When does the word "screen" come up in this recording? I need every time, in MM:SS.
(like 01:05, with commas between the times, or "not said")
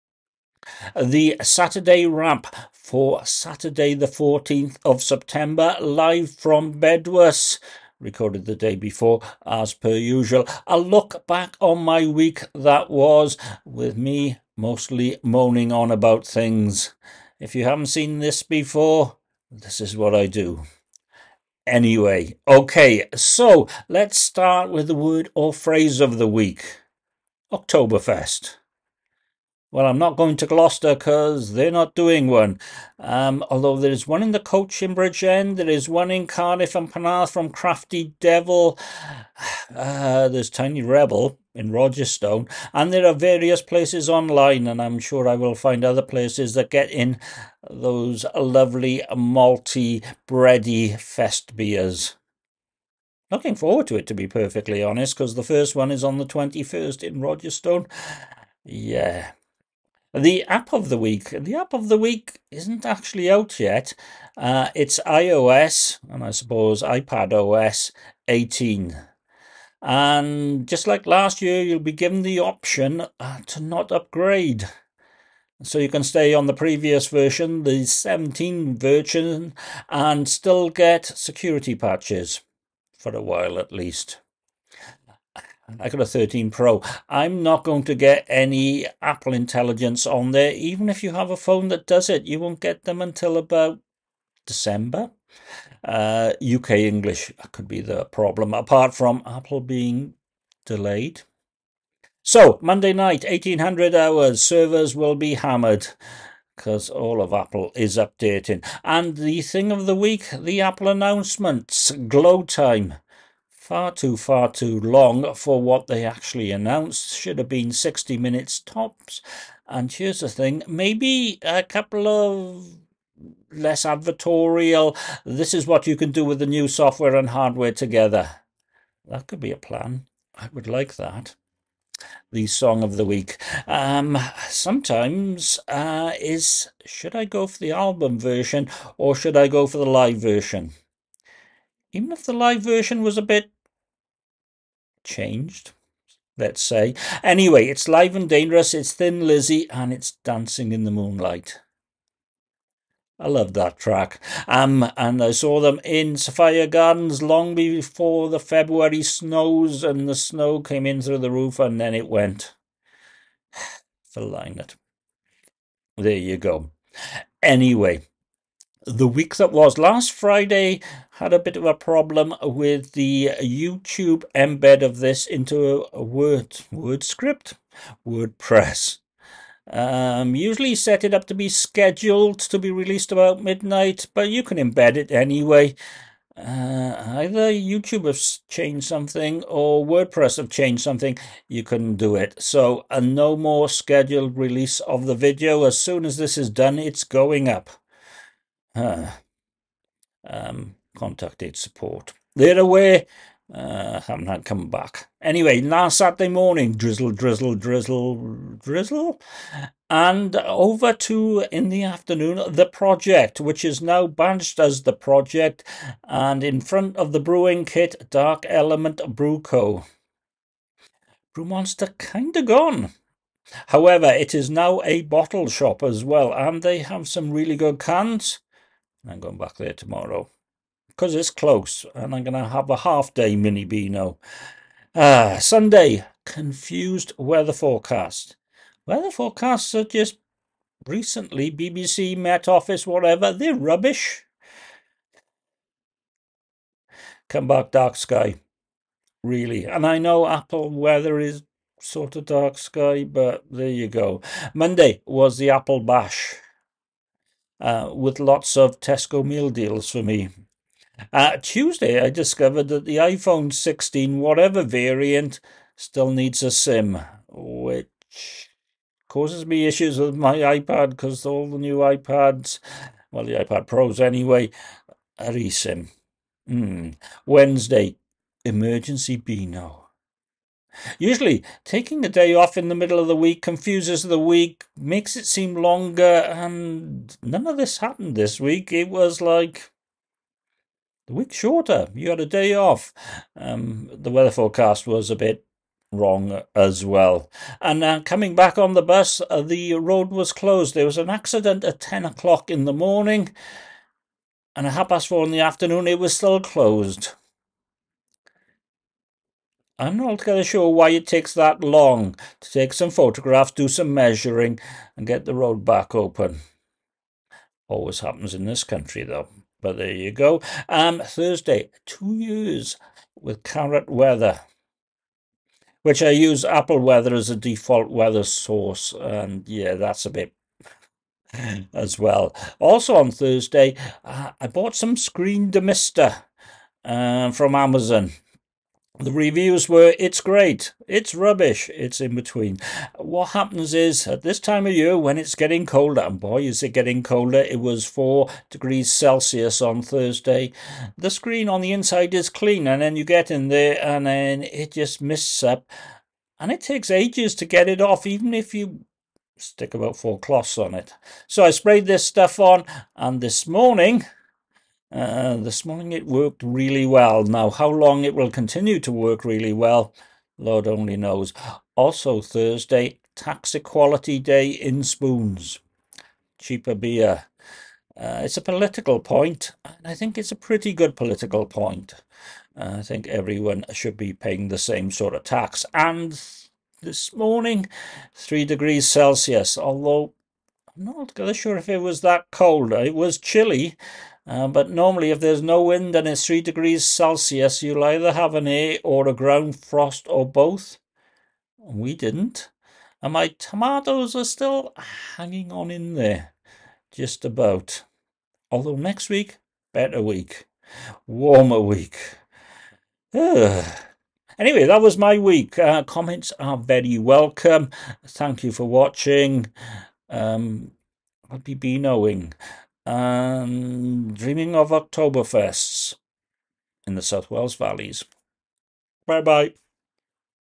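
05:34, 05:51.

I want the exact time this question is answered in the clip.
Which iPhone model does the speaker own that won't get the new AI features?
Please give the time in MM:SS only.
01:26.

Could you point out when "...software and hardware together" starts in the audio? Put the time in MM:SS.
02:06.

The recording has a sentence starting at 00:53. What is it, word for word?
Looking forward to it, to be perfectly honest, because the first one is on the 21st in Rogerstone.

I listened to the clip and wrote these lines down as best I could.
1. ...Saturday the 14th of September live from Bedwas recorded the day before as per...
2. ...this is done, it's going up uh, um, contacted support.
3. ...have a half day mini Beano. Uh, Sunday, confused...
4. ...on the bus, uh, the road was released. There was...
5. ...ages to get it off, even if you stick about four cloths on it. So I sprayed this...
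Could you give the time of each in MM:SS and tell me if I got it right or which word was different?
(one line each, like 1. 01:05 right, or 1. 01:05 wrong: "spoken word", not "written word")
1. 00:03 right
2. 03:16 right
3. 03:52 right
4. 04:58 wrong: "closed", not "released"
5. 05:56 right.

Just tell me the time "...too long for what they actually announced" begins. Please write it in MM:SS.
01:54.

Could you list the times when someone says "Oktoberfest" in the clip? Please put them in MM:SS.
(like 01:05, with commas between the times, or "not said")
00:27, 07:04.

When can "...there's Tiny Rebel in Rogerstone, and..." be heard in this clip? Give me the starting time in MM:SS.
00:40.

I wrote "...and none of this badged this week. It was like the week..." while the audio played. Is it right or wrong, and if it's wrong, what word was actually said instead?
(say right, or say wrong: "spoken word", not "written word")
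wrong: "happened", not "badged".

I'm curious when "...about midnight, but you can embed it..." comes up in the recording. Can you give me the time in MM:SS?
03:03.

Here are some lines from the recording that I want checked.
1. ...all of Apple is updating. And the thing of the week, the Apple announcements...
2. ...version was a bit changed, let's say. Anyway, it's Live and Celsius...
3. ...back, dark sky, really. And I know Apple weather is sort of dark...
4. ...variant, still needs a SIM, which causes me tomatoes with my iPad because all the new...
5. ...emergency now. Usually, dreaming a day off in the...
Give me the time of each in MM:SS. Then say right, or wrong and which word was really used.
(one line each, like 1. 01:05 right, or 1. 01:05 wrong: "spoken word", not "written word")
1. 01:46 right
2. 02:22 wrong: "Dangerous", not "Celsius"
3. 04:07 right
4. 04:24 wrong: "issues", not "tomatoes"
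5. 04:38 wrong: "taking", not "dreaming".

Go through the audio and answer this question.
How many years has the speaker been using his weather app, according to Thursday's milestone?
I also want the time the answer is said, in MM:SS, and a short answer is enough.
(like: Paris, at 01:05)
2, at 05:21.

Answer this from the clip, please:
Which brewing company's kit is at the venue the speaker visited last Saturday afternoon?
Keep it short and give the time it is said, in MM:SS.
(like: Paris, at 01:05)
Dark Element Brewco, at 03:38.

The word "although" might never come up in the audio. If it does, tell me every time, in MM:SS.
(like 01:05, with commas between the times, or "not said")
00:33, 06:29, 06:48.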